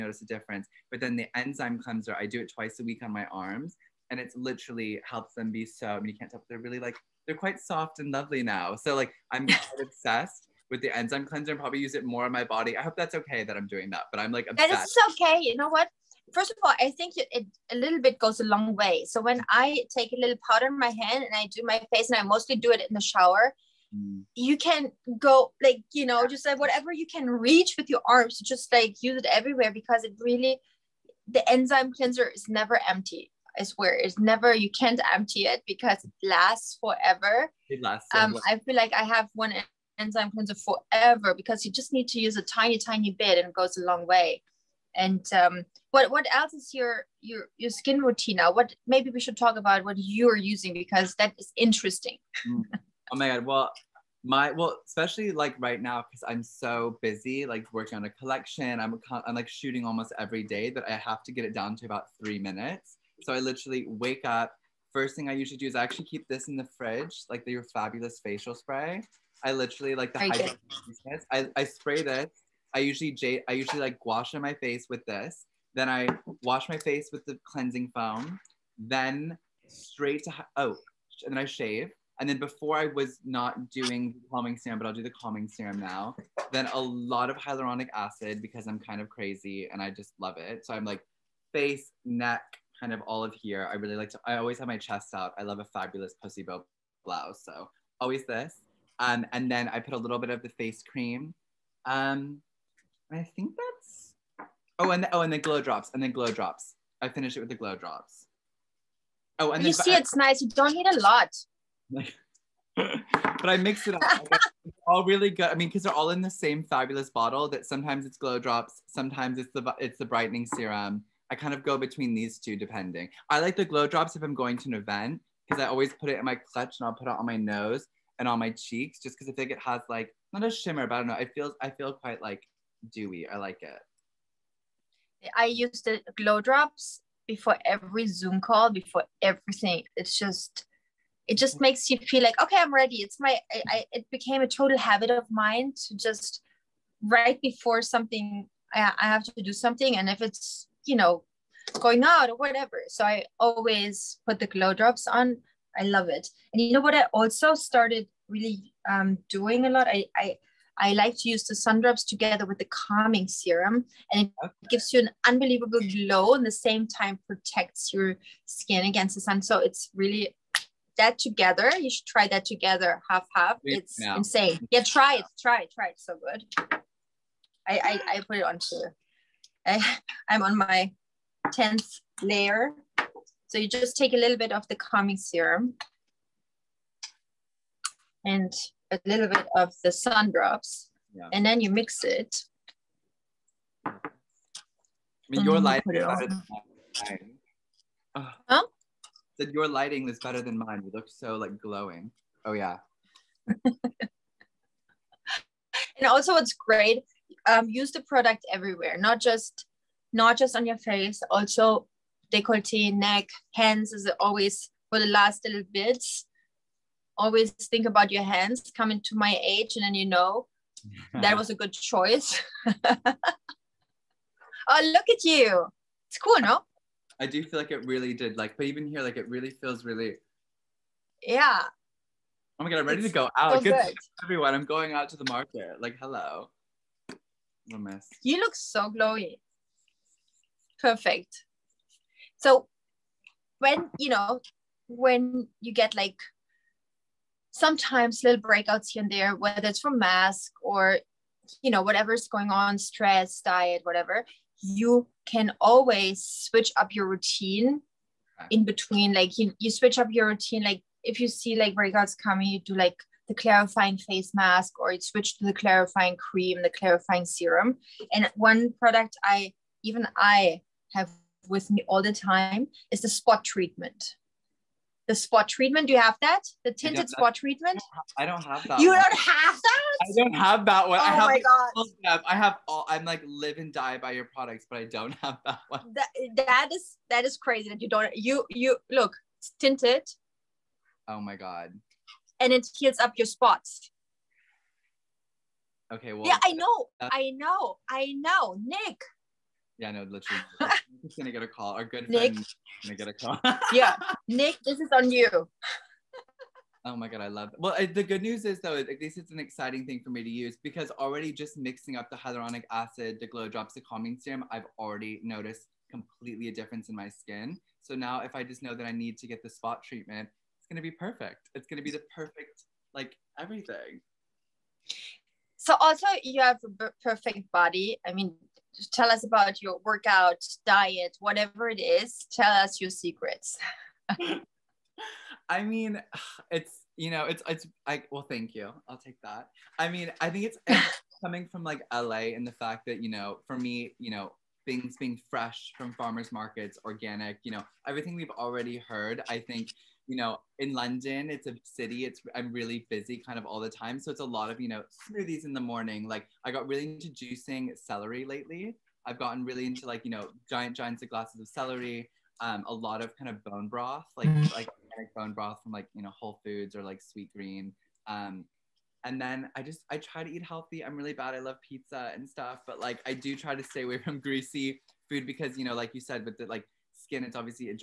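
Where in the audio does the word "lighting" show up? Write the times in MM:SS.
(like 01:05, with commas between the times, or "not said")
03:15, 03:19.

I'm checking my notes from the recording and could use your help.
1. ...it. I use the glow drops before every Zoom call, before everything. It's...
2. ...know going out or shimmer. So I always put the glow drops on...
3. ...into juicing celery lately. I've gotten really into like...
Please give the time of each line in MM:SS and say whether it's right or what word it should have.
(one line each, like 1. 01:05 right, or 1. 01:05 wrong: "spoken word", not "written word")
1. 02:13 right
2. 02:30 wrong: "whatever", not "shimmer"
3. 05:56 right.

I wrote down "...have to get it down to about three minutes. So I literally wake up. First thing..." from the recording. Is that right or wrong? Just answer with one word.
right.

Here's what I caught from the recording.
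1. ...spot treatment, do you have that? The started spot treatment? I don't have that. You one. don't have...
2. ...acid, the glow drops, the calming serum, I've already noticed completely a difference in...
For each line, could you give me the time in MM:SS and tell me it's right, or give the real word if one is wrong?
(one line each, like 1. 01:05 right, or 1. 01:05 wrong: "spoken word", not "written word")
1. 04:35 wrong: "tinted", not "started"
2. 05:12 right.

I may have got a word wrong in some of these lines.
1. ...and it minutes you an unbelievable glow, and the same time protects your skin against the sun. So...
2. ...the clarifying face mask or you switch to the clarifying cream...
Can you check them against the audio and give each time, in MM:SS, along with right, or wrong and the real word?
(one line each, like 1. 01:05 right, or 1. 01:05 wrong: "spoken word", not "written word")
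1. 02:44 wrong: "gives", not "minutes"
2. 04:23 right.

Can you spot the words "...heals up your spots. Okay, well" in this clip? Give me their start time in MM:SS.
04:52.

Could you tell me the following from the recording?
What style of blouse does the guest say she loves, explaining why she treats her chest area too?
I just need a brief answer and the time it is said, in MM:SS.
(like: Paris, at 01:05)
pussy bow blouse, at 01:36.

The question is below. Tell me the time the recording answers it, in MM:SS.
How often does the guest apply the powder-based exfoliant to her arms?
00:02.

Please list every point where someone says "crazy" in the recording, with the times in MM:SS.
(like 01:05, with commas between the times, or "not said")
01:29, 04:47.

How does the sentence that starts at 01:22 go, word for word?
And then before I was not doing the calming serum, but I'll do the calming serum now.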